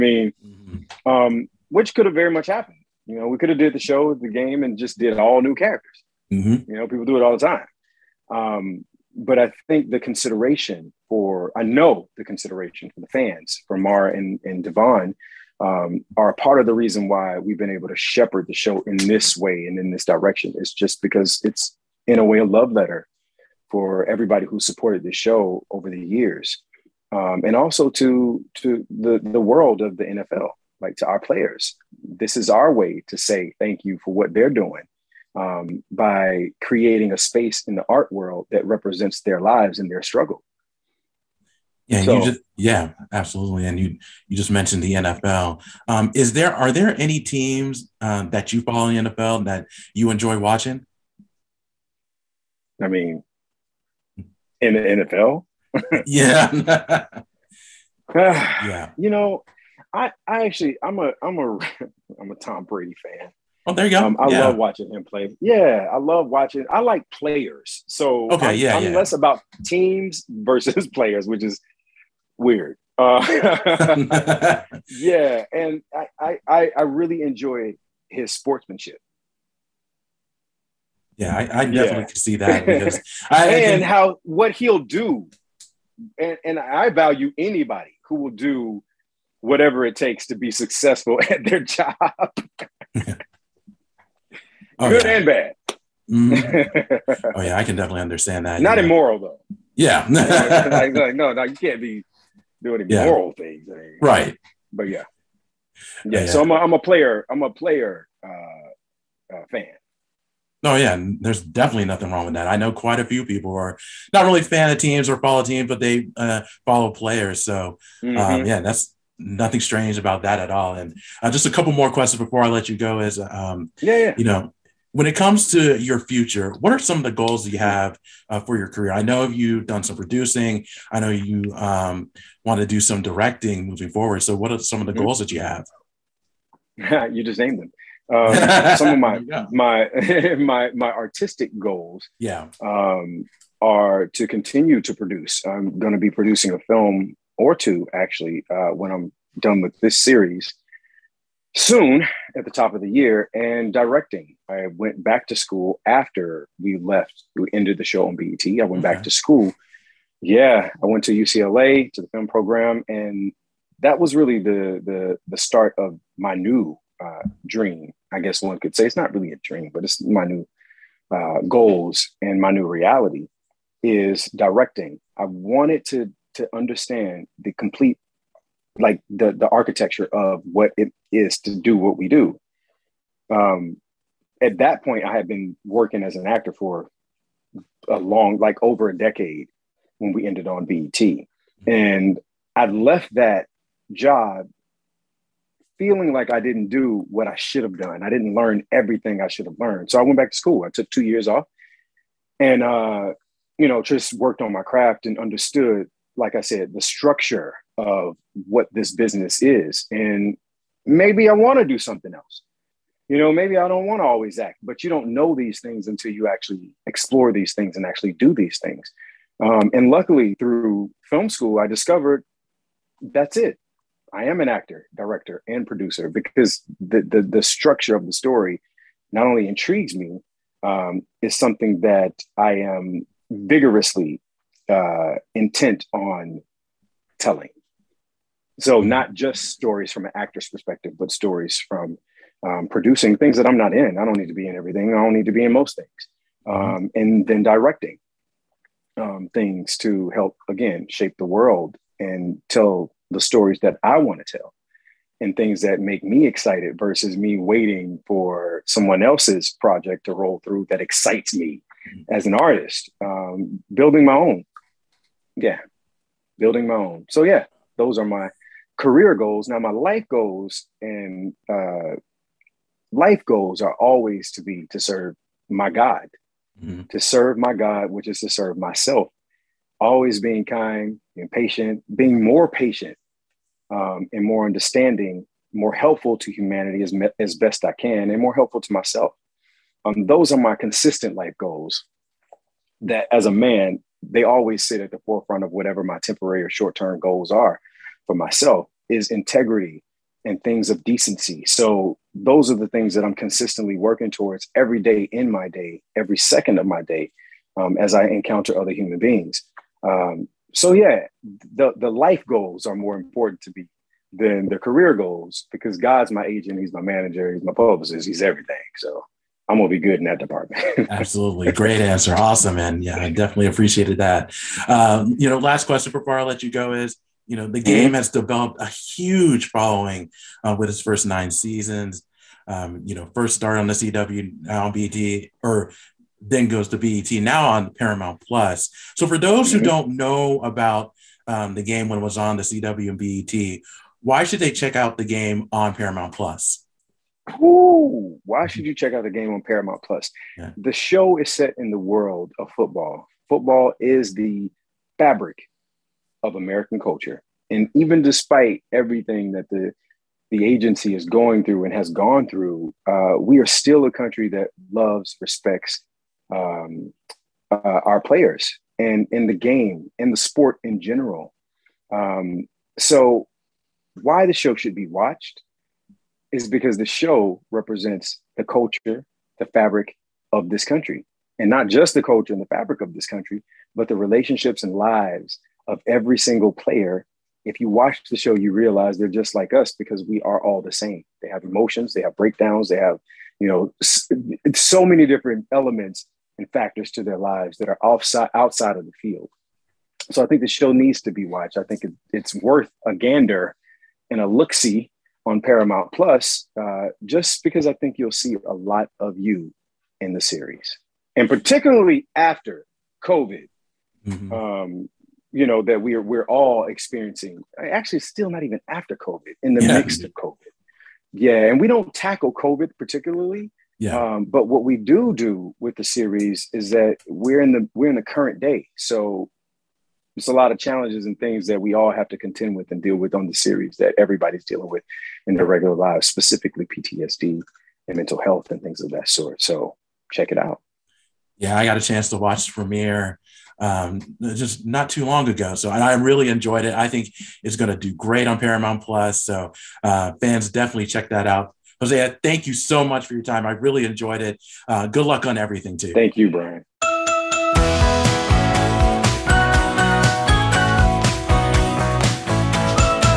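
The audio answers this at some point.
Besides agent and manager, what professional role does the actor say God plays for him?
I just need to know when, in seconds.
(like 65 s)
317 s.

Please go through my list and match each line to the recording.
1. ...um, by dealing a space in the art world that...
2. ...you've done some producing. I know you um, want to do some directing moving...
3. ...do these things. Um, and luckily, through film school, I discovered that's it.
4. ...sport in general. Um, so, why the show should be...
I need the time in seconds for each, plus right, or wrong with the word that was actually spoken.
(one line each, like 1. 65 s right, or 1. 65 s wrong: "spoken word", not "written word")
1. 35 s wrong: "creating", not "dealing"
2. 129 s right
3. 218 s right
4. 370 s right.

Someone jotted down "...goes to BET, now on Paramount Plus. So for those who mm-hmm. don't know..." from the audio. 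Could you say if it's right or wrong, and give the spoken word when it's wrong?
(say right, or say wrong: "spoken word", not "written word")
right.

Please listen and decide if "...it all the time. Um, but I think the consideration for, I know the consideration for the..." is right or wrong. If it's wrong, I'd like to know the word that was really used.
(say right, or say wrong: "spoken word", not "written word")
right.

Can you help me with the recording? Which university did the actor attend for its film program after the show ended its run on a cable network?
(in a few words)
UCLA.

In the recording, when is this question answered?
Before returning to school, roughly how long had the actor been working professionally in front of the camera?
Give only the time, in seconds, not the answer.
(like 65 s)
188 s.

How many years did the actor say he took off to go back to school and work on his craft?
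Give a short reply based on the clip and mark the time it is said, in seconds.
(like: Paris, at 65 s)
2, at 200 s.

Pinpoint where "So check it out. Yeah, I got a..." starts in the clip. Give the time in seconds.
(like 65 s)
439 s.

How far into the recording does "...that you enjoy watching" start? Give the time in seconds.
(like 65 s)
49 s.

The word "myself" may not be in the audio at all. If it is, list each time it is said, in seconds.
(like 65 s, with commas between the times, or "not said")
278 s, 288 s, 298 s.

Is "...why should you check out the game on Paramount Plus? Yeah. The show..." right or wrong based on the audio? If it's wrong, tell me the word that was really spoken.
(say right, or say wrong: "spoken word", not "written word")
right.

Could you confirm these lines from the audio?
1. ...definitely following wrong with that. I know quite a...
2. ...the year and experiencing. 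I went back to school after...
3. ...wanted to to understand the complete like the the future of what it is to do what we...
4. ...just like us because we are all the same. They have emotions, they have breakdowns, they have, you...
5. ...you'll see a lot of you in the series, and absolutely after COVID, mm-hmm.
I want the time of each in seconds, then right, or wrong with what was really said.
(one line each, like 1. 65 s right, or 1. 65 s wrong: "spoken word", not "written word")
1. 111 s wrong: "nothing", not "following"
2. 152 s wrong: "directing", not "experiencing"
3. 175 s wrong: "architecture", not "future"
4. 389 s right
5. 407 s wrong: "particularly", not "absolutely".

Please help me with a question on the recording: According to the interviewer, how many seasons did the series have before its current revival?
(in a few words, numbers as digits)
9.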